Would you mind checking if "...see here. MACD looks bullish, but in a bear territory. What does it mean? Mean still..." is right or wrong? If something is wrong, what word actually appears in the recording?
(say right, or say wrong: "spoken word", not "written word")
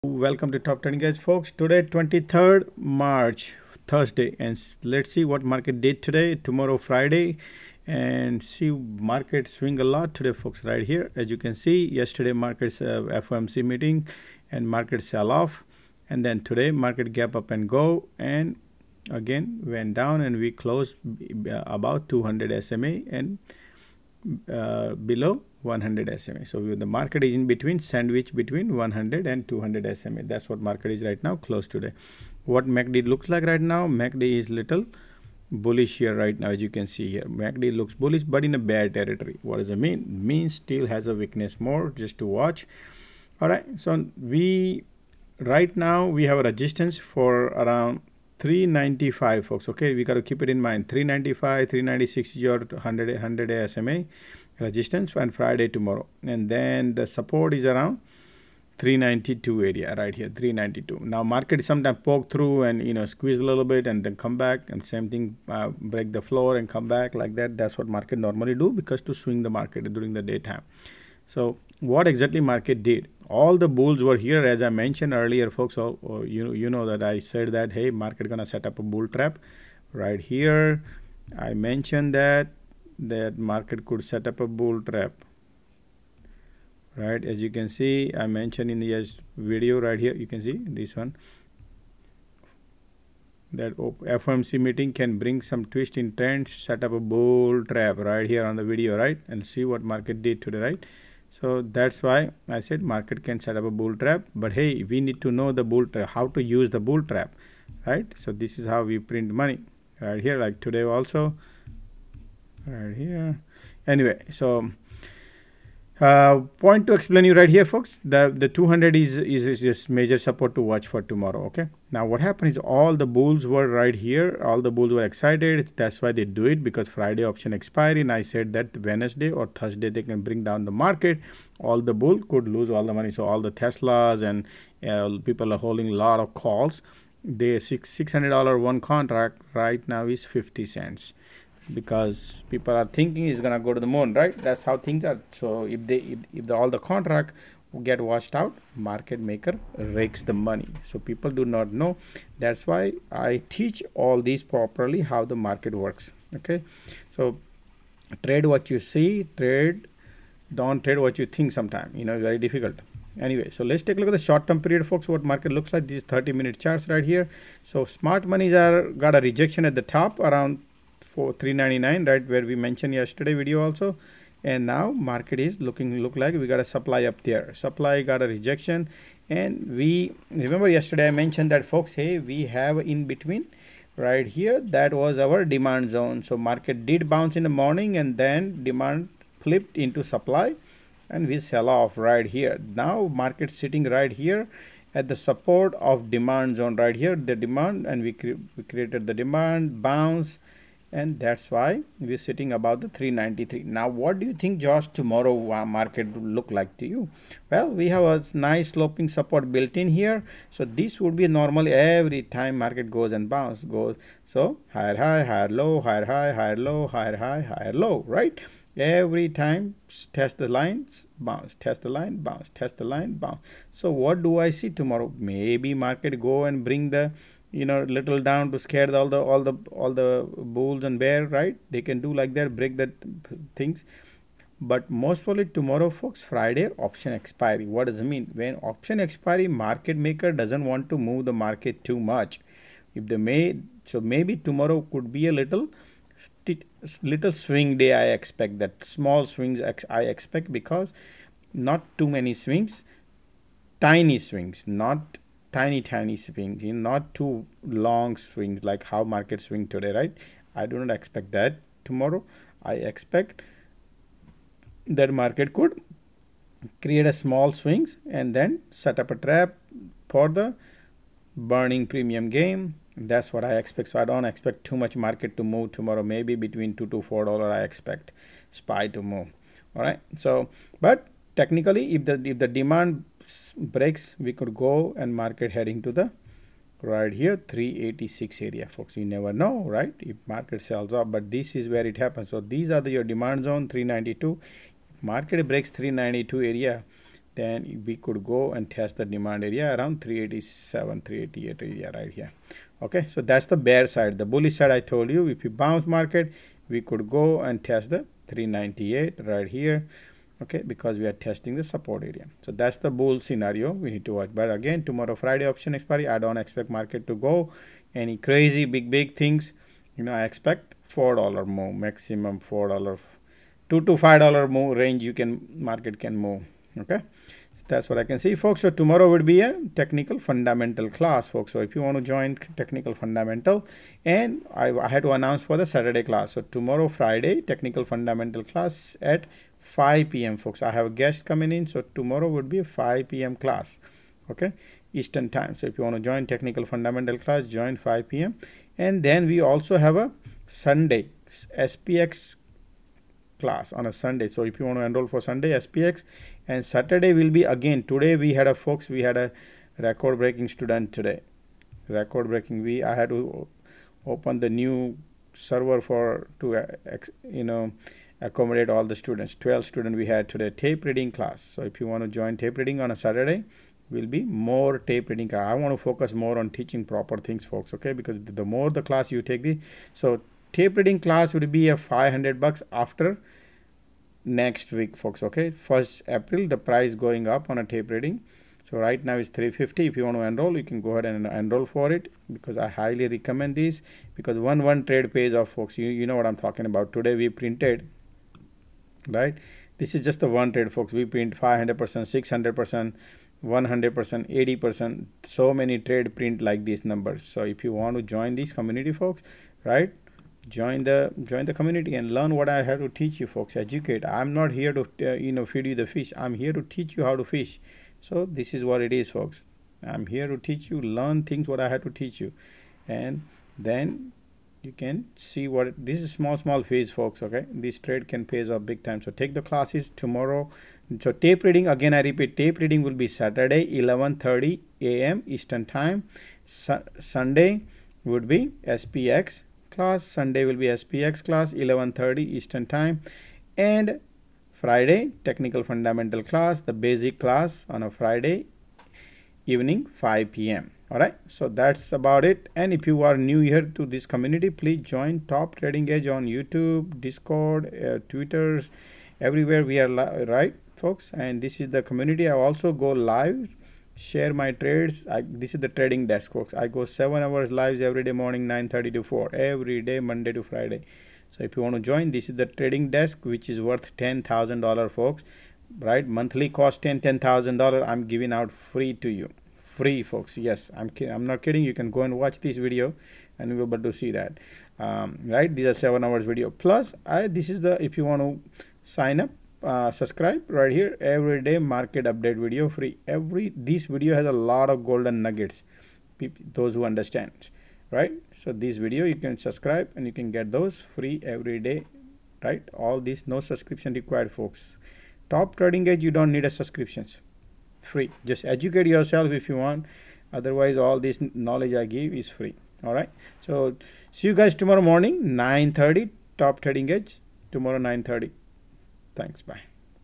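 right.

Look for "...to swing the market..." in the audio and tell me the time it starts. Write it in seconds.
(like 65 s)
69 s.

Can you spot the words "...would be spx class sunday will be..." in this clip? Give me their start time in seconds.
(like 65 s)
438 s.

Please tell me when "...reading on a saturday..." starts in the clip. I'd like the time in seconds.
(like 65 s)
372 s.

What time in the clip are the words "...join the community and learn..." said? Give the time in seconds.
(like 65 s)
411 s.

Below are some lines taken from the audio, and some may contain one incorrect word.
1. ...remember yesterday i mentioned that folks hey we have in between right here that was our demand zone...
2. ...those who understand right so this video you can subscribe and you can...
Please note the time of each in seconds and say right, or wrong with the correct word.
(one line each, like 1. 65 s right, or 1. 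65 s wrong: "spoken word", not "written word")
1. 180 s right
2. 496 s right.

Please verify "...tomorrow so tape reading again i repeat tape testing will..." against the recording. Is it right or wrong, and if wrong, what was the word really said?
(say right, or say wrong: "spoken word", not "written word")
wrong: "reading", not "testing".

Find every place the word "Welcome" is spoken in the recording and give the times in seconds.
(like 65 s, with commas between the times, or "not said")
0 s.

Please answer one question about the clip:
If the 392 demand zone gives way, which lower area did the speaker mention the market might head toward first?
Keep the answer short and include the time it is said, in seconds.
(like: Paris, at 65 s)
386, at 287 s.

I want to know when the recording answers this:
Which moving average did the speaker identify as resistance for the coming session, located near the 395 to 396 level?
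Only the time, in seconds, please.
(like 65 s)
52 s.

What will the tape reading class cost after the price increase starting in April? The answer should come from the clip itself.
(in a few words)
500 bucks.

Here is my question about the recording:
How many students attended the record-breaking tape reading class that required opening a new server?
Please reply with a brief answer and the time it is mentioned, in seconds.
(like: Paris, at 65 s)
12, at 369 s.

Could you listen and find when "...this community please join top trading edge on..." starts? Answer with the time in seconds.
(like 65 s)
453 s.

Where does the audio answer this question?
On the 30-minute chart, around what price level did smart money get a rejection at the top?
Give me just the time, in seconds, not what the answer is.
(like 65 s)
171 s.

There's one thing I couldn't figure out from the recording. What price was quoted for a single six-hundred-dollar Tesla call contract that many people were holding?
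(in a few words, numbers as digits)
50 cents.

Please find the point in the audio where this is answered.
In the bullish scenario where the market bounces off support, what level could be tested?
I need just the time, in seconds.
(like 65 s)
308 s.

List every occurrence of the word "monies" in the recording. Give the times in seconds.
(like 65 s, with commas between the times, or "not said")
168 s.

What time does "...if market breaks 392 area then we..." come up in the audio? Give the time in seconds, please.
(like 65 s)
294 s.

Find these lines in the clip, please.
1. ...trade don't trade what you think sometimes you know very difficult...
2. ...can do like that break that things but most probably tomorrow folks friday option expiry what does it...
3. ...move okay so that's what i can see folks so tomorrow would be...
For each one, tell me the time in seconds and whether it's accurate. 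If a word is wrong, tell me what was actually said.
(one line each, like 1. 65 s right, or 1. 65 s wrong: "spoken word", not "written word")
1. 159 s right
2. 231 s right
3. 326 s right.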